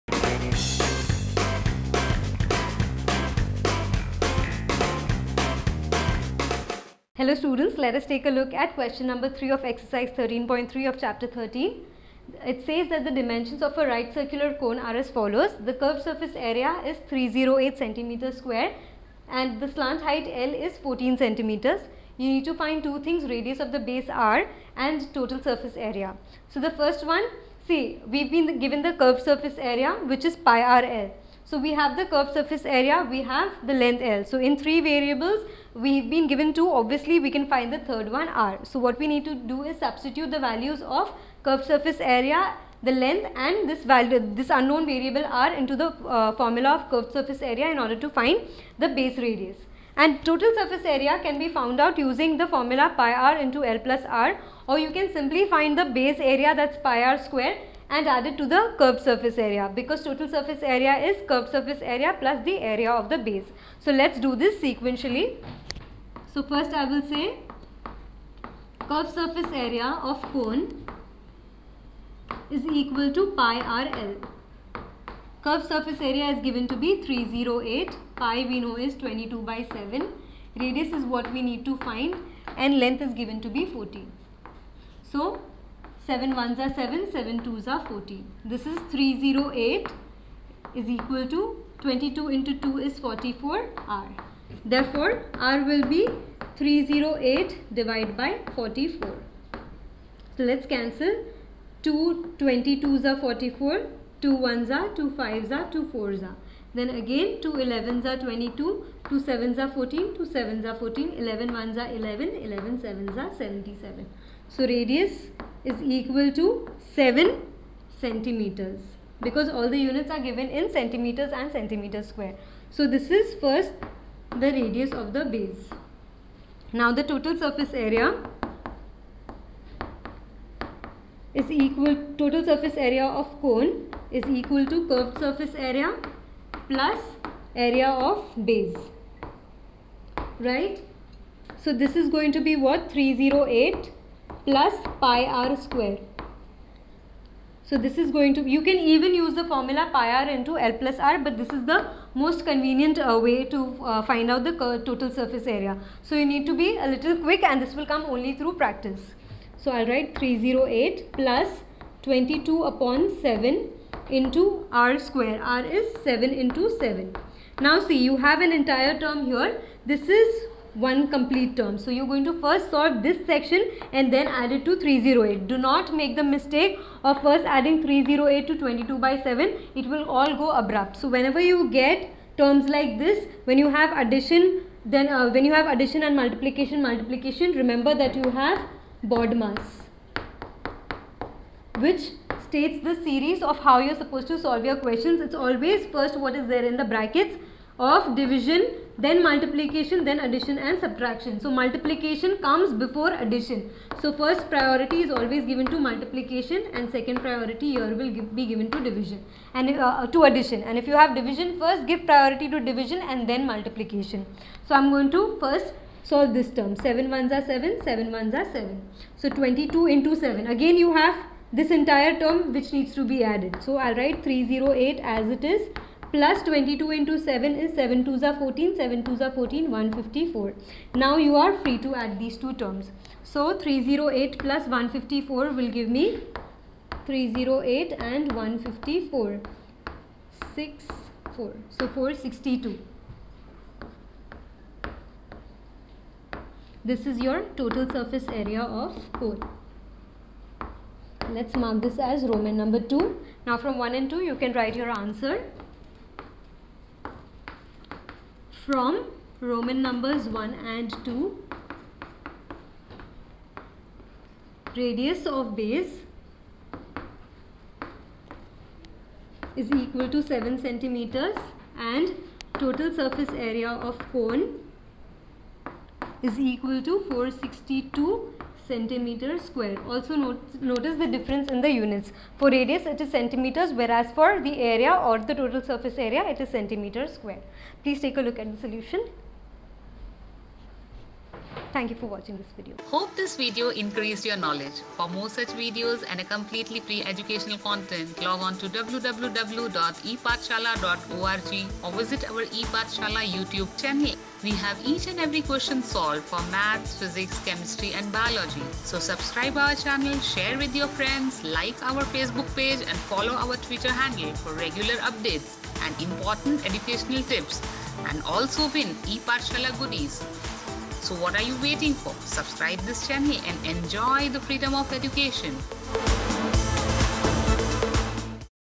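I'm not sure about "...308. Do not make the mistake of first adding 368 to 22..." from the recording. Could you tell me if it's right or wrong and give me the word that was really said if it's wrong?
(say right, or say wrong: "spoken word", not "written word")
wrong: "308", not "368".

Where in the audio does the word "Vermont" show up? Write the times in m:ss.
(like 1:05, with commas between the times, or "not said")
not said.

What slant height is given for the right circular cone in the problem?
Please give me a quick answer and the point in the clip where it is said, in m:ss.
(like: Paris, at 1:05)
14 centimeters, at 0:20.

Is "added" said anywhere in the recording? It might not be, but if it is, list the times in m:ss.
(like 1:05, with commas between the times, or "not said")
0:58, 3:43.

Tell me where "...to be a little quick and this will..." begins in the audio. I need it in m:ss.
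2:36.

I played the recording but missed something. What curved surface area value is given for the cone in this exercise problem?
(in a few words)
308 square centimeters.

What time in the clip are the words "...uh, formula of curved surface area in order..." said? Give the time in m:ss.
0:45.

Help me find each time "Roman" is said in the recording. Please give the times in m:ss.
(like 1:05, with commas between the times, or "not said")
4:12, 4:19.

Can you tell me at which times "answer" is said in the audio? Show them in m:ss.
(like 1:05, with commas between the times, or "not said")
4:14.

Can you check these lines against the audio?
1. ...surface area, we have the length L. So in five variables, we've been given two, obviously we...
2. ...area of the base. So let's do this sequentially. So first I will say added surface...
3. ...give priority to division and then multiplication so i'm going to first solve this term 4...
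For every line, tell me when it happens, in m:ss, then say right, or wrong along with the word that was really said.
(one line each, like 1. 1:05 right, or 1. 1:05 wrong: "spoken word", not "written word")
1. 0:32 wrong: "three", not "five"
2. 1:02 wrong: "curved", not "added"
3. 3:31 wrong: "7", not "4".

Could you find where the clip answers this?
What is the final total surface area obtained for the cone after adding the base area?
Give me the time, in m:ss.
4:37.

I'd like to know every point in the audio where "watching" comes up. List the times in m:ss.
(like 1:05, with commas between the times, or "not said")
4:52.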